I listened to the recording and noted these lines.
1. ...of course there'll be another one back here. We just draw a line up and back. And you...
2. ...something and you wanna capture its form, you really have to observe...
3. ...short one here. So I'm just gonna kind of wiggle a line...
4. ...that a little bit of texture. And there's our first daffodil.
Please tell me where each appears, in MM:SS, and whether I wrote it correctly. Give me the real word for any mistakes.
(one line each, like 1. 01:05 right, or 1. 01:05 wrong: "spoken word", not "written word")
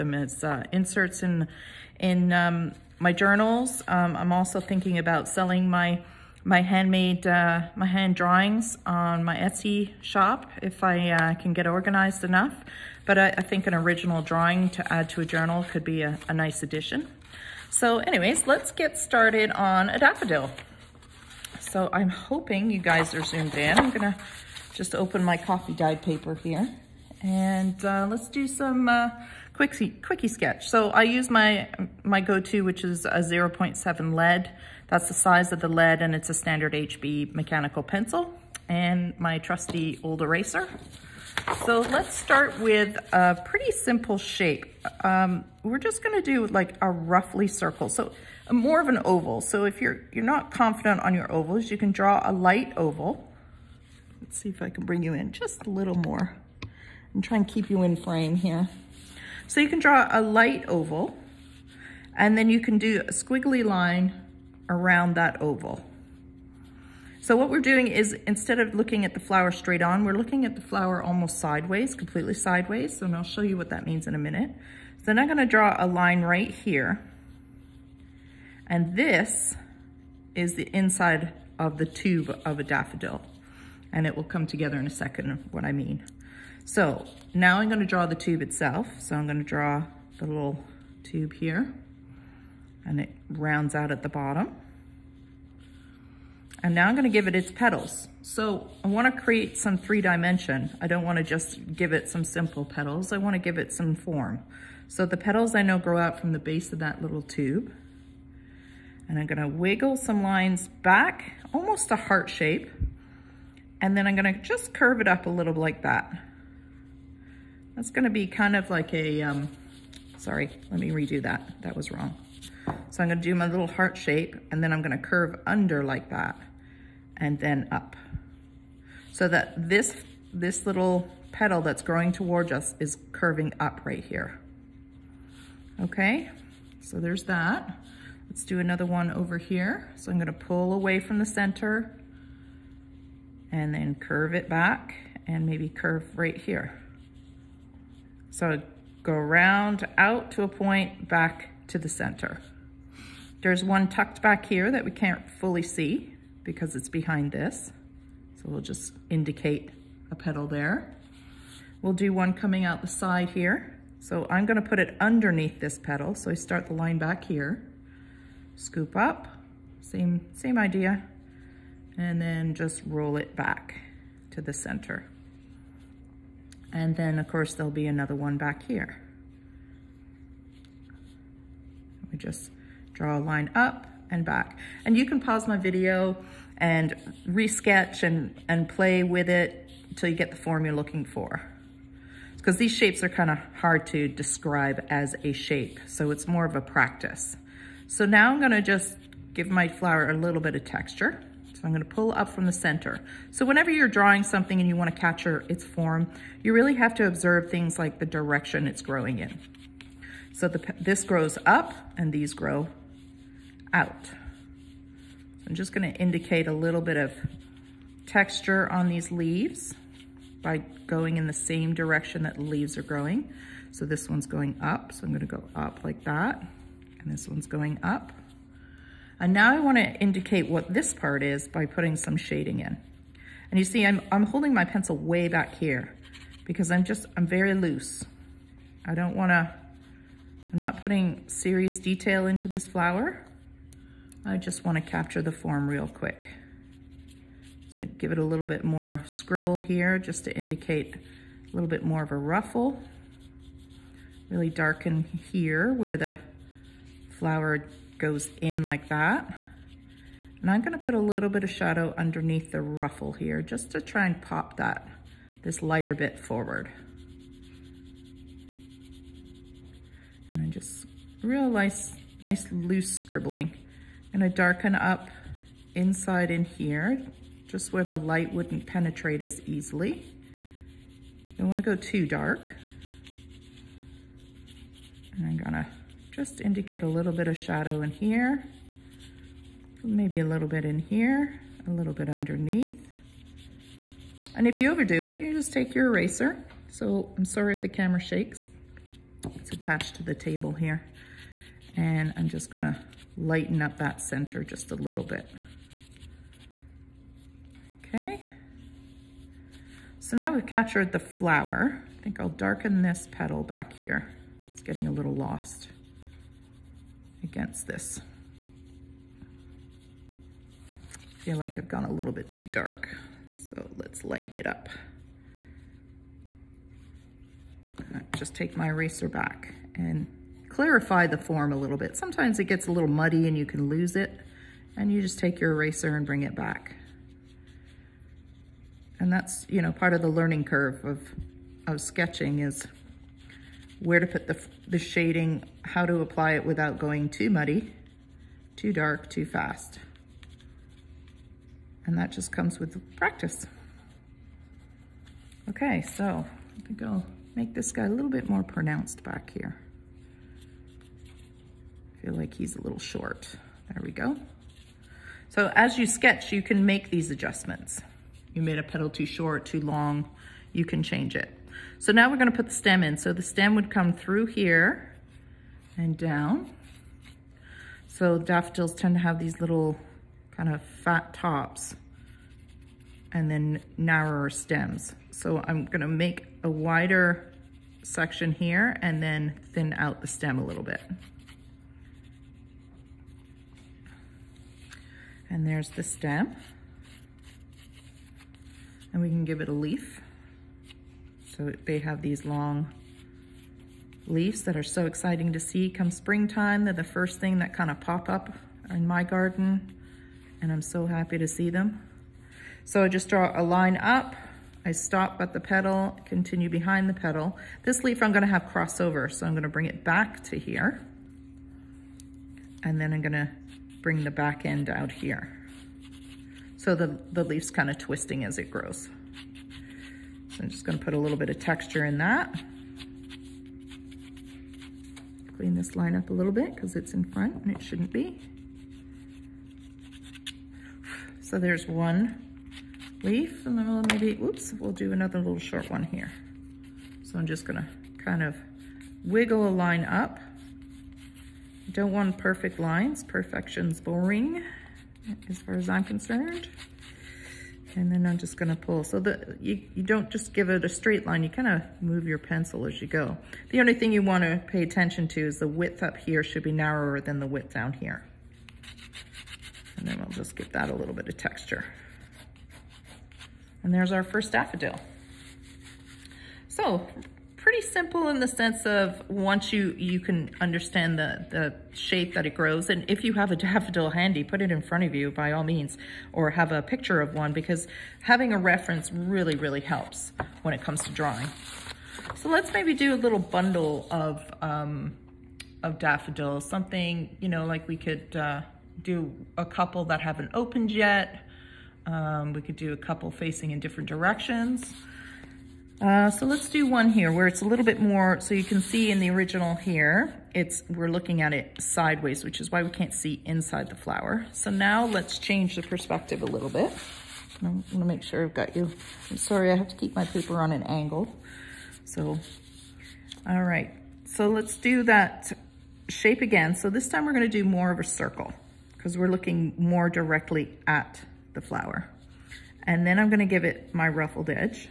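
1. 02:57 right
2. 03:24 right
3. 07:25 right
4. 07:50 right.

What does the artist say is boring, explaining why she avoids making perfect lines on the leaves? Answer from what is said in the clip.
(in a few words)
perfection.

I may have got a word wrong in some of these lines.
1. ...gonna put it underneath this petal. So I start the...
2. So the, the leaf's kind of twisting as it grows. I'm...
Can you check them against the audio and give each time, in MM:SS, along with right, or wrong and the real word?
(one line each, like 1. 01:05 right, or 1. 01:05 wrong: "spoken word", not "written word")
1. 02:44 right
2. 07:06 right.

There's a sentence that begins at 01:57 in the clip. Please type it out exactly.
That's gonna be kind of like a, um, sorry, let me redo that.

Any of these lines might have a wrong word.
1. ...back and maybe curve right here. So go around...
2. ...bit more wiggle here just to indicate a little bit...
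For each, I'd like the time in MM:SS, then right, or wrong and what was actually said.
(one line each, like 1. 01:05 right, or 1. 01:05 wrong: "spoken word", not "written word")
1. 02:24 right
2. 04:08 wrong: "scribble", not "wiggle".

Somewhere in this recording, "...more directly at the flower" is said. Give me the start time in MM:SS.
08:49.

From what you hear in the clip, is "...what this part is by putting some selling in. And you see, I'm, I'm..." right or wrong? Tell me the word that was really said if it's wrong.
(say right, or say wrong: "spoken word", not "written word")
wrong: "shading", not "selling".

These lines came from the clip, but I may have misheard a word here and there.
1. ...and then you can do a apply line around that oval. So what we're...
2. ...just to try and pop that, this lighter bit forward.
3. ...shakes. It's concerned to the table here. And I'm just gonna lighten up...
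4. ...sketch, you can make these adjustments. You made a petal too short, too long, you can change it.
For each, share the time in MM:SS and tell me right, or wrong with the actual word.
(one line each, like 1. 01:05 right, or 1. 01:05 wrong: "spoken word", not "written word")
1. 01:02 wrong: "squiggly", not "apply"
2. 04:23 right
3. 04:58 wrong: "attached", not "concerned"
4. 06:05 right.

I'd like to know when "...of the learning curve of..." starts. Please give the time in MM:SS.
05:39.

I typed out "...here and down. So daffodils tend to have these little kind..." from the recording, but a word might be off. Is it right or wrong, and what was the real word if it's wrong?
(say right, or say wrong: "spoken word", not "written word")
right.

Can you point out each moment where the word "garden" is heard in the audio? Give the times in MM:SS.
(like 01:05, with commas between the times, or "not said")
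06:49.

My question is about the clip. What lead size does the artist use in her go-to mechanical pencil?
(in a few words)
0.7.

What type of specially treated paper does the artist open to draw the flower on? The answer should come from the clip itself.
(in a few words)
coffee dyed paper.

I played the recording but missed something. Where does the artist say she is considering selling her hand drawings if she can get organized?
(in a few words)
Etsy shop.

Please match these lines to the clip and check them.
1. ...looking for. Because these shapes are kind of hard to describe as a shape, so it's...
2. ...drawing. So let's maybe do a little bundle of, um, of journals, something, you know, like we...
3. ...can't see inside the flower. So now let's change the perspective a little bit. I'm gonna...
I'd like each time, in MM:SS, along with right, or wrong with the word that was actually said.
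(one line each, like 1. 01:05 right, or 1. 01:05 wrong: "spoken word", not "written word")
1. 03:10 right
2. 08:10 wrong: "daffodils", not "journals"
3. 08:32 right.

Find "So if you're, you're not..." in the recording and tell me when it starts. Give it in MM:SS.
00:49.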